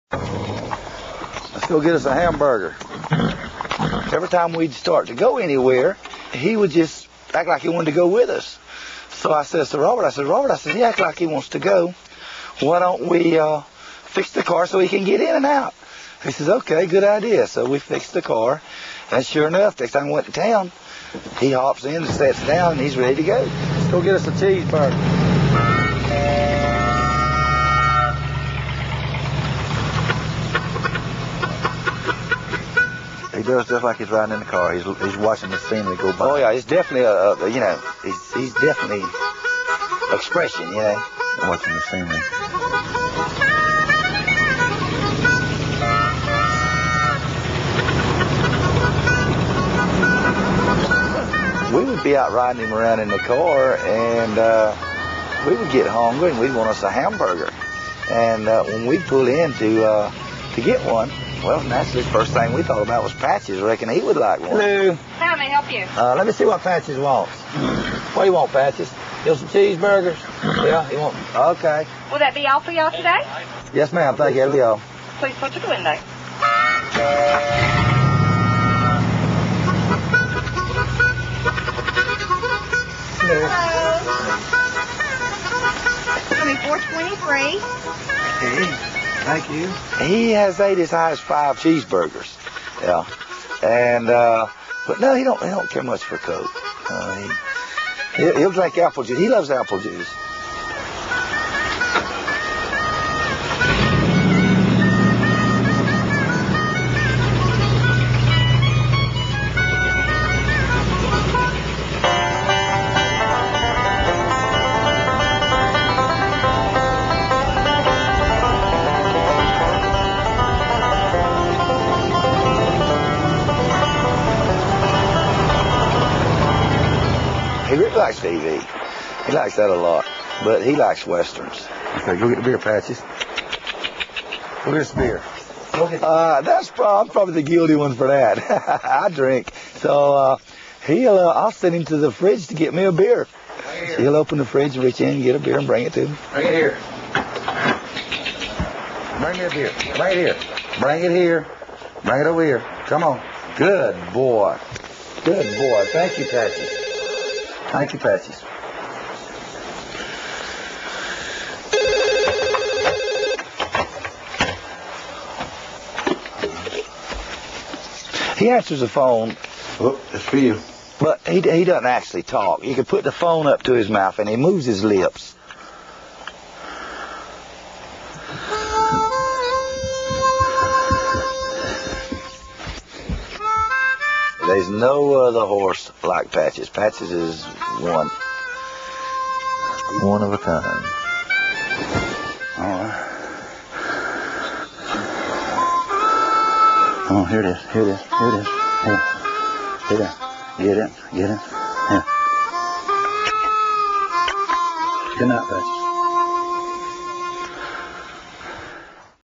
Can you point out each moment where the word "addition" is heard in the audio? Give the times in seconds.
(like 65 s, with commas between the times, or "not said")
not said.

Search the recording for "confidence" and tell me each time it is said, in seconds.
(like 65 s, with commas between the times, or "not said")
not said.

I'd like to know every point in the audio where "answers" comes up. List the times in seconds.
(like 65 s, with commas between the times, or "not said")
168 s.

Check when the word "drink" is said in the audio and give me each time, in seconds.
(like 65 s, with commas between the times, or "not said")
98 s, 139 s.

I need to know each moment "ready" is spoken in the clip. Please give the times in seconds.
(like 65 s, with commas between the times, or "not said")
22 s.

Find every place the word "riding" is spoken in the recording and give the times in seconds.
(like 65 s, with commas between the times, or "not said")
34 s, 52 s.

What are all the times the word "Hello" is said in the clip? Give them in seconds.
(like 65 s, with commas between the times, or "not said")
64 s, 83 s.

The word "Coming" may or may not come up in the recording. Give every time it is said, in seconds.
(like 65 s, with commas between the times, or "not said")
86 s.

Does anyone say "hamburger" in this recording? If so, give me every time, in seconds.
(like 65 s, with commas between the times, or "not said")
2 s, 56 s.